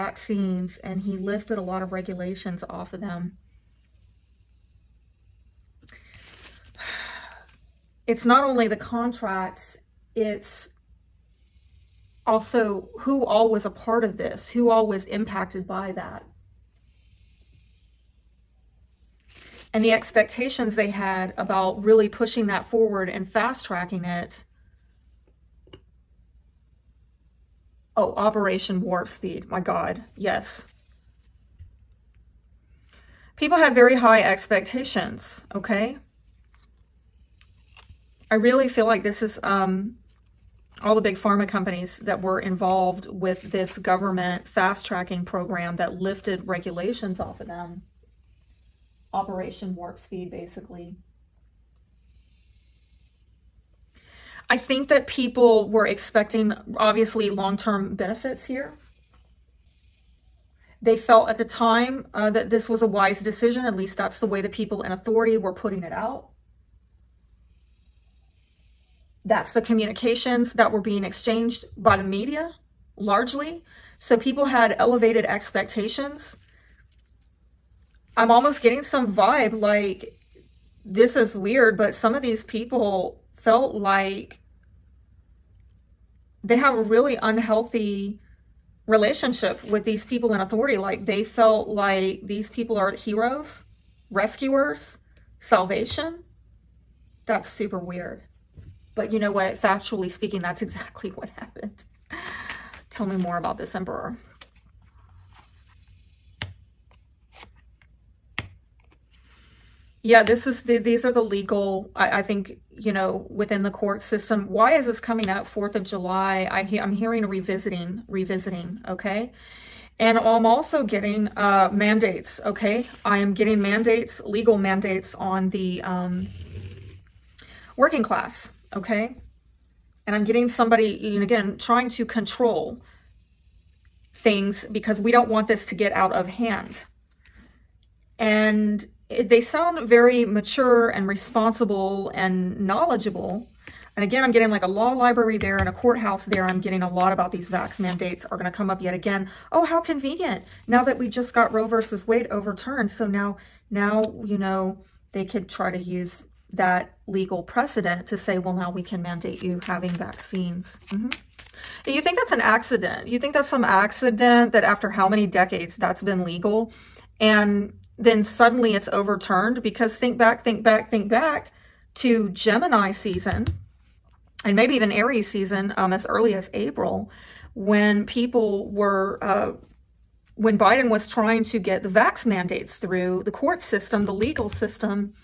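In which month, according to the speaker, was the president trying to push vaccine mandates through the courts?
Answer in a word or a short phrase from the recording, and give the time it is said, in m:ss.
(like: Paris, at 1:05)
April, at 2:56.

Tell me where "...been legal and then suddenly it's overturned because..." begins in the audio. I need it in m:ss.
2:46.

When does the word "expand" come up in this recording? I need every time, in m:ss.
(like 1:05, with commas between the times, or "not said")
not said.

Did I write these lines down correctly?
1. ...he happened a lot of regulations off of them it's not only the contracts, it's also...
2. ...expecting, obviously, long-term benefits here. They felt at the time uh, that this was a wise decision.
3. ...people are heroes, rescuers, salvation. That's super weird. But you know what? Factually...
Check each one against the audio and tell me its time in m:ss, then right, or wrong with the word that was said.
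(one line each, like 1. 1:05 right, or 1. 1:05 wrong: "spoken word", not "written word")
1. 0:01 wrong: "lifted", not "happened"
2. 0:55 right
3. 1:32 right.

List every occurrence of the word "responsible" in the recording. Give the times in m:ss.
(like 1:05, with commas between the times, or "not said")
2:21.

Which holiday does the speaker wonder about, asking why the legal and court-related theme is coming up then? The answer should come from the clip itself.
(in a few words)
4th of July.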